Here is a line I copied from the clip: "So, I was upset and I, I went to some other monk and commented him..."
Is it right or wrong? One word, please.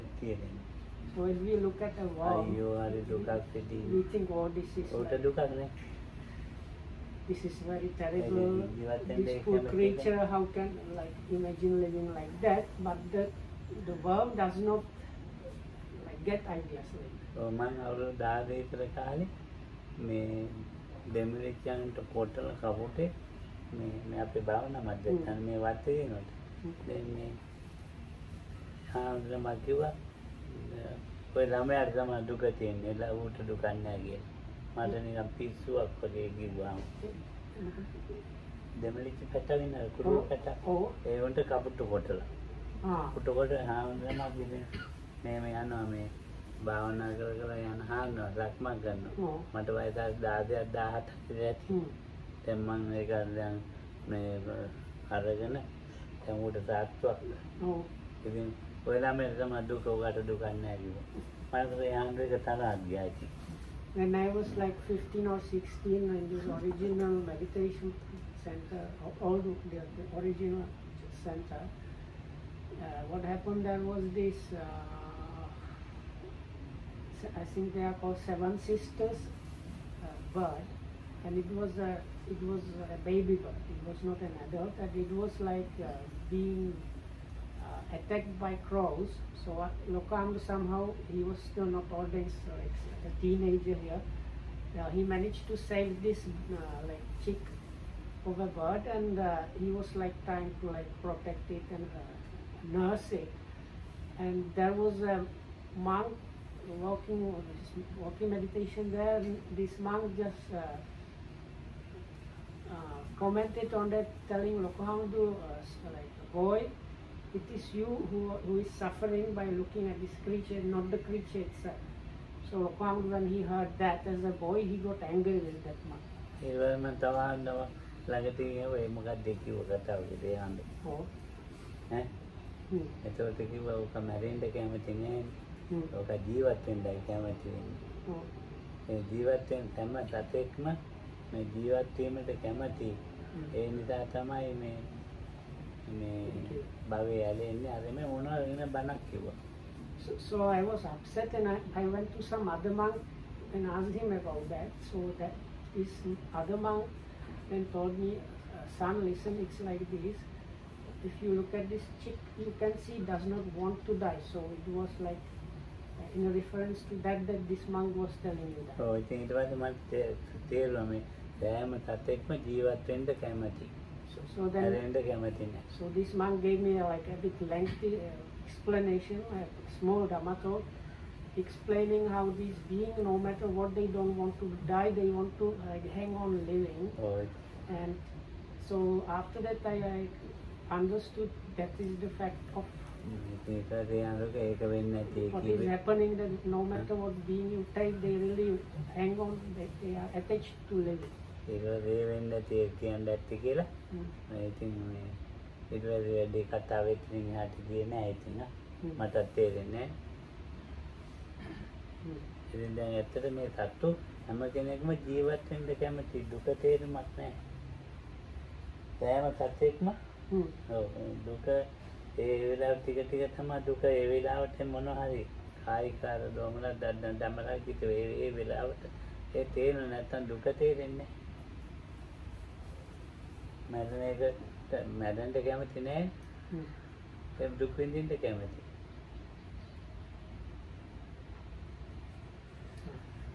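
wrong.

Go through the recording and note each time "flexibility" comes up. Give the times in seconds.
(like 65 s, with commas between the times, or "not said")
not said.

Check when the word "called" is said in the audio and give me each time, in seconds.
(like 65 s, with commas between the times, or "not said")
77 s.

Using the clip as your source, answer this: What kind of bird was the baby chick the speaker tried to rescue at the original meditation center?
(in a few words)
Seven Sisters.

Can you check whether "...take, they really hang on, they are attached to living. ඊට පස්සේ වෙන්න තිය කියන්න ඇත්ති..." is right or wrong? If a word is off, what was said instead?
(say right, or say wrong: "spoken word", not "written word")
right.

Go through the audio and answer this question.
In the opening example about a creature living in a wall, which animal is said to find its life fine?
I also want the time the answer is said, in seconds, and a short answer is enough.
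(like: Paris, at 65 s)
worm, at 14 s.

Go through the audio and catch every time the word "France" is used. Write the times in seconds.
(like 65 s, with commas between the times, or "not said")
not said.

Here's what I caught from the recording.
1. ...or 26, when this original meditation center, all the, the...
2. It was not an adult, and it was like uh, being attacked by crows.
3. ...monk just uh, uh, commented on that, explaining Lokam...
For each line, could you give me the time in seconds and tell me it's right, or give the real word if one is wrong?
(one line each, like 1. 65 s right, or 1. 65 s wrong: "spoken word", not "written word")
1. 65 s wrong: "16", not "26"
2. 83 s right
3. 109 s wrong: "telling", not "explaining".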